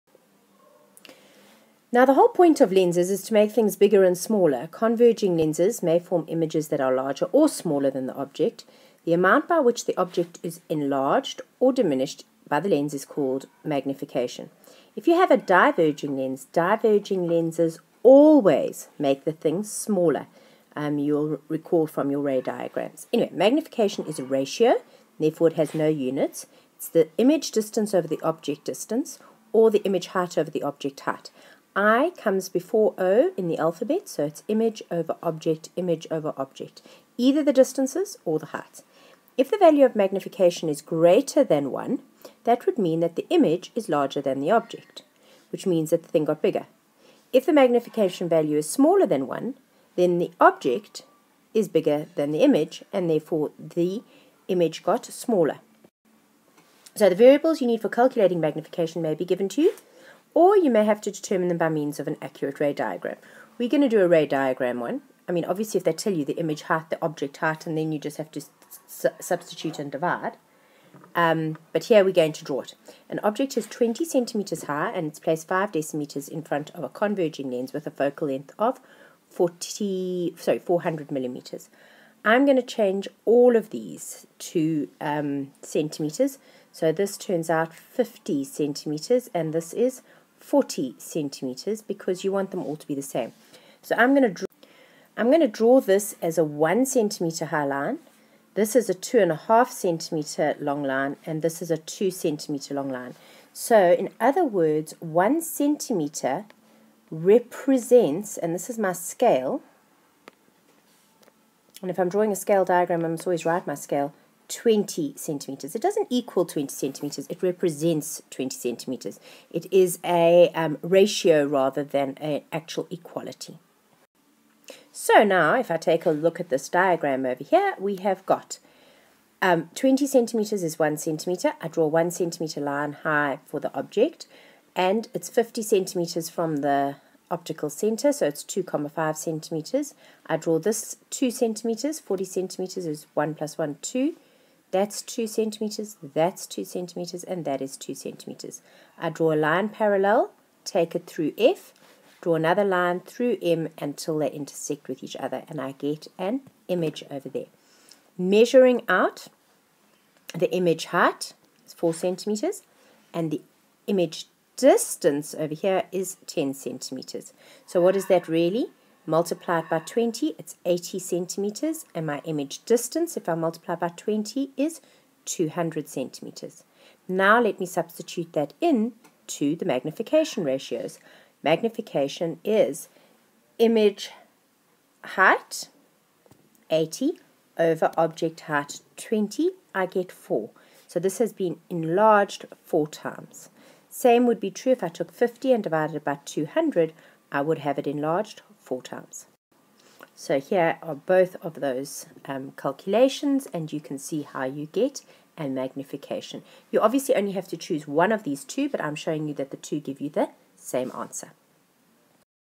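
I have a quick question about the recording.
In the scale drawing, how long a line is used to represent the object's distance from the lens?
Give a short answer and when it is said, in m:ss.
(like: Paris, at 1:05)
2.5 centimeters, at 1:38.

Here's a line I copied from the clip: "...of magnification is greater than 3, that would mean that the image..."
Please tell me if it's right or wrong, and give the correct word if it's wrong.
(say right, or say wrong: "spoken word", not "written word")
wrong: "1", not "3".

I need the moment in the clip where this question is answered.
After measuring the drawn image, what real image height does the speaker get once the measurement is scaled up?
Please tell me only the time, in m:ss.
2:50.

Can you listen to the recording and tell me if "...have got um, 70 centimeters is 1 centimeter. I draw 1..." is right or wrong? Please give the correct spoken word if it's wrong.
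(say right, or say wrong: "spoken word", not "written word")
wrong: "20", not "70".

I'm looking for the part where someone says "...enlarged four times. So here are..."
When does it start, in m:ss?
3:17.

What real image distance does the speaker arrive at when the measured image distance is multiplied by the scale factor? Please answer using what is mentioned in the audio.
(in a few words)
200 centimeters.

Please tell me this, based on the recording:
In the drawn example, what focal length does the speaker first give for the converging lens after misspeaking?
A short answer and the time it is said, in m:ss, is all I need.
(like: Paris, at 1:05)
400 millimeters, at 1:20.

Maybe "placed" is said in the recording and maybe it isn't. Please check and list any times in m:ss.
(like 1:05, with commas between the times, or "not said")
1:15.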